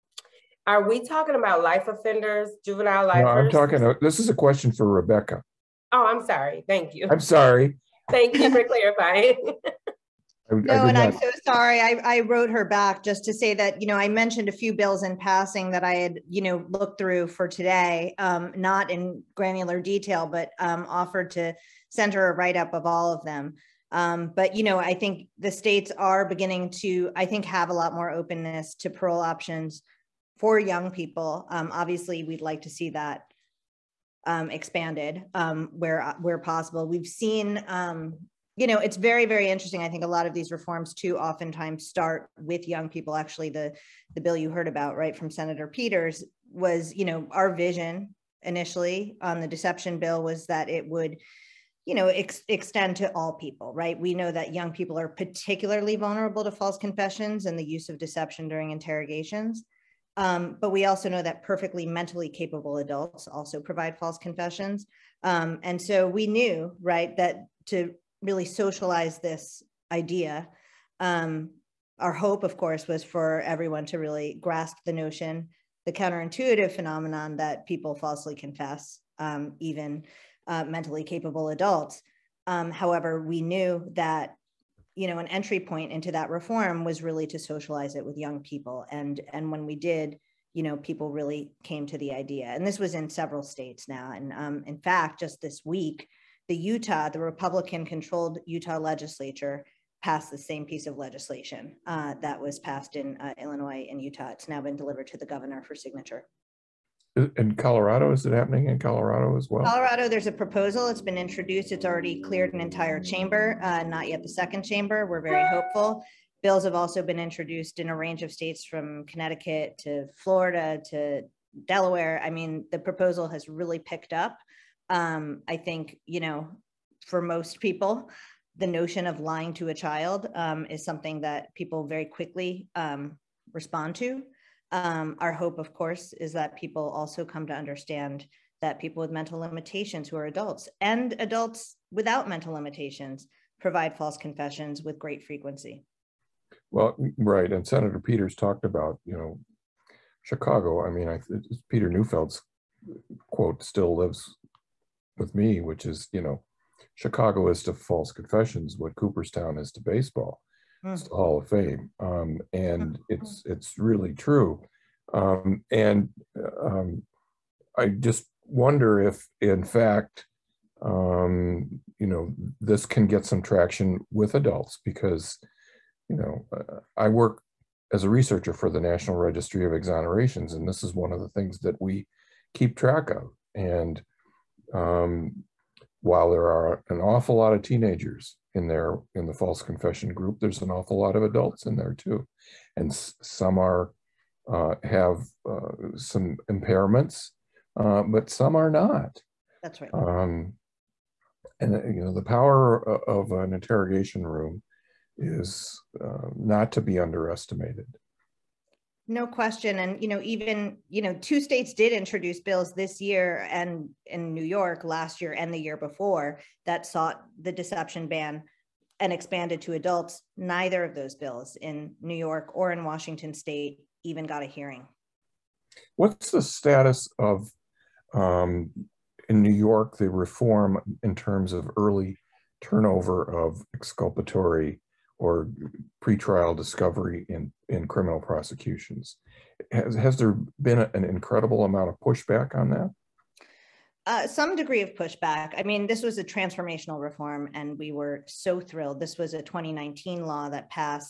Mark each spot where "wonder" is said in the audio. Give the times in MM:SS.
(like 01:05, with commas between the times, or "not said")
02:48.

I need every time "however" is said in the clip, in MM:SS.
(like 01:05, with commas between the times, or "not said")
01:22.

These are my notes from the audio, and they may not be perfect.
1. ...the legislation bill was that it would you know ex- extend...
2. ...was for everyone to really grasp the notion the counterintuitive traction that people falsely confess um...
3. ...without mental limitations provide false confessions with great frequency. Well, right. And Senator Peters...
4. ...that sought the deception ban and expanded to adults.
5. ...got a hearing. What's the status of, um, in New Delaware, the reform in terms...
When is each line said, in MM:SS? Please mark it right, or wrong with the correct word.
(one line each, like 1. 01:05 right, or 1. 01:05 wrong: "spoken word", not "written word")
1. 00:49 wrong: "deception", not "legislation"
2. 01:12 wrong: "phenomenon", not "traction"
3. 02:21 right
4. 03:36 right
5. 03:44 wrong: "York", not "Delaware".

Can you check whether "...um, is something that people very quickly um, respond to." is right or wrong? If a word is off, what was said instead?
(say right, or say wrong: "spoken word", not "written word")
right.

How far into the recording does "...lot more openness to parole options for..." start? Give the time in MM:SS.
00:27.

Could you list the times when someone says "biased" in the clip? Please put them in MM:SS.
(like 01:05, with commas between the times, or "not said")
not said.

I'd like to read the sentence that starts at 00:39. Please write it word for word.
I think a lot of these reforms too oftentimes start with young people.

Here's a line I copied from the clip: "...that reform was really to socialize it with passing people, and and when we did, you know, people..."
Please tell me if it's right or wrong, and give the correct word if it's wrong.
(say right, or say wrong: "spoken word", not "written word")
wrong: "young", not "passing".